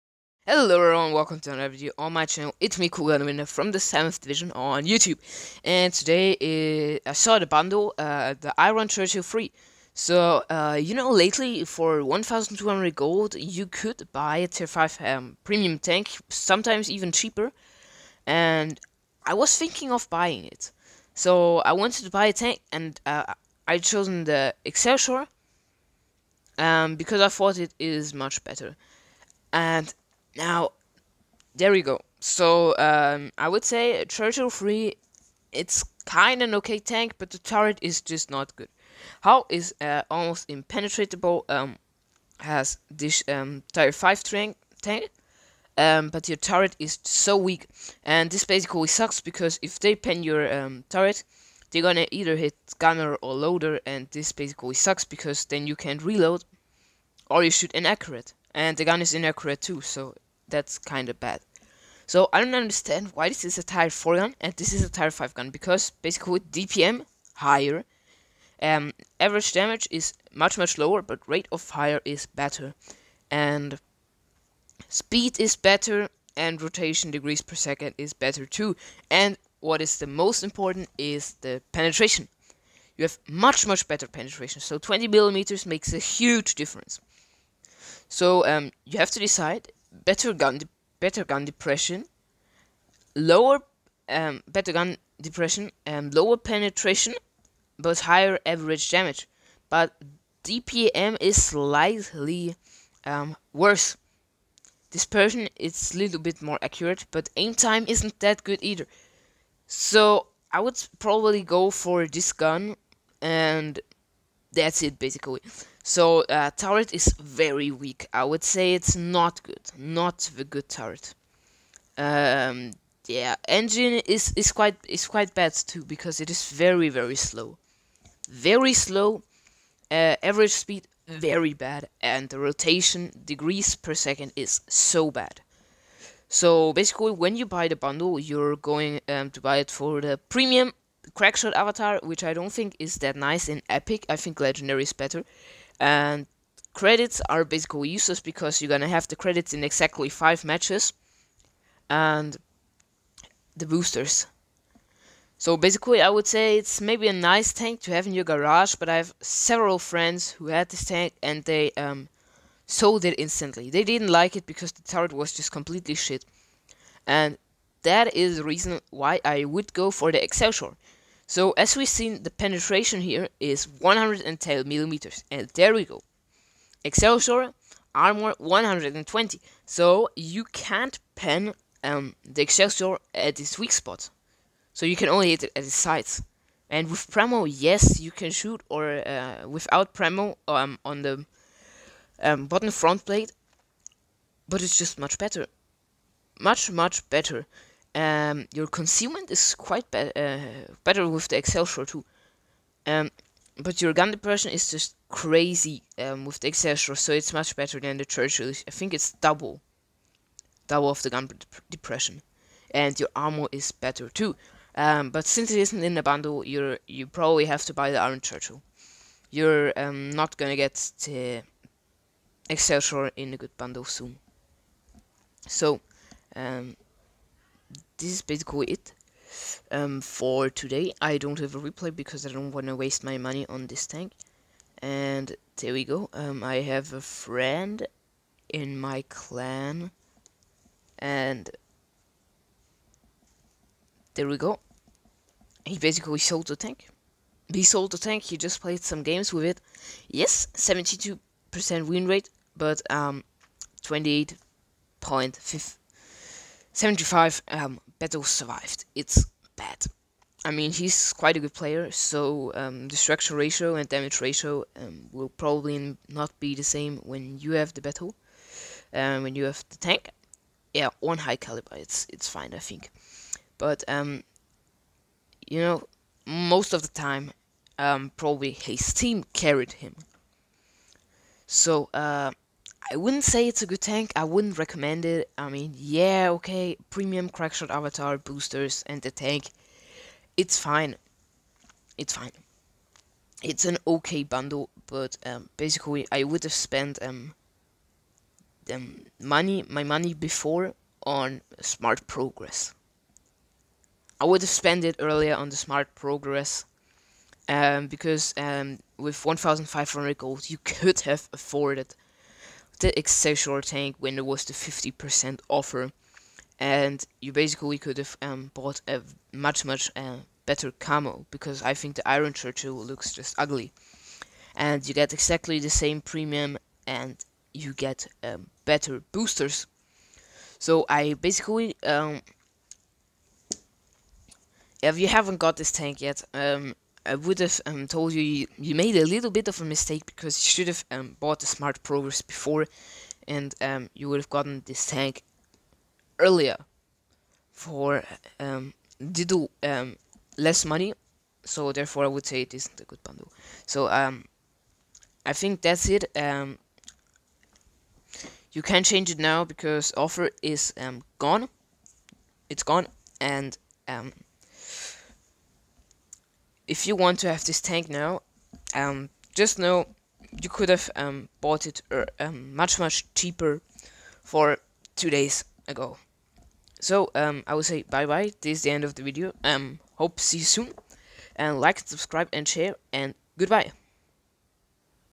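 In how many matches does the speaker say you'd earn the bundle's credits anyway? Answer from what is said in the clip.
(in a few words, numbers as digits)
5.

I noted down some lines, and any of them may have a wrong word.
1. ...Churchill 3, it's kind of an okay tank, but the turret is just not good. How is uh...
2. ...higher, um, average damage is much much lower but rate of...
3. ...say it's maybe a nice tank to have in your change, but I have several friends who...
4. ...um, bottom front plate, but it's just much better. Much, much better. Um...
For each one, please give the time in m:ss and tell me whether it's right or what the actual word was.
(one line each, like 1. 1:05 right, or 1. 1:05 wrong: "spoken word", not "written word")
1. 0:34 right
2. 1:07 right
3. 2:36 wrong: "garage", not "change"
4. 3:12 right.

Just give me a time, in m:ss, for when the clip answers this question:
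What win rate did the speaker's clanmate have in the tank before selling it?
4:10.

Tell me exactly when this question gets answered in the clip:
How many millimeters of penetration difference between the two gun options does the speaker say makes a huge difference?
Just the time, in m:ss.
1:24.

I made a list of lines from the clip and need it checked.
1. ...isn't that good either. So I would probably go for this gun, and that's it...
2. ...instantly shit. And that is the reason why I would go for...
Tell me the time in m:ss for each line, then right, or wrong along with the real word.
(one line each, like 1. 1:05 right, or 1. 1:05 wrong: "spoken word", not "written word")
1. 1:47 right
2. 2:45 wrong: "completely", not "instantly".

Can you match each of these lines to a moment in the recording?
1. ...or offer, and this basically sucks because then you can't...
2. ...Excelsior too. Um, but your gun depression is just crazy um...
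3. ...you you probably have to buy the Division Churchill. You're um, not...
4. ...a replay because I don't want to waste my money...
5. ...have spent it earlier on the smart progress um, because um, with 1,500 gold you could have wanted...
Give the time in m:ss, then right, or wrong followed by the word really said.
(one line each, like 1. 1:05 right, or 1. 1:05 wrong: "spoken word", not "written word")
1. 0:53 wrong: "loader", not "offer"
2. 3:21 right
3. 3:36 wrong: "Iron", not "Division"
4. 3:51 right
5. 5:04 wrong: "afforded", not "wanted".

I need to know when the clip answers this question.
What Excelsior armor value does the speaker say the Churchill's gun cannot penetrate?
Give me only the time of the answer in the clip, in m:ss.
2:57.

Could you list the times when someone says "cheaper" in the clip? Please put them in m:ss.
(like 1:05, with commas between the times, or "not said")
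0:17, 6:13.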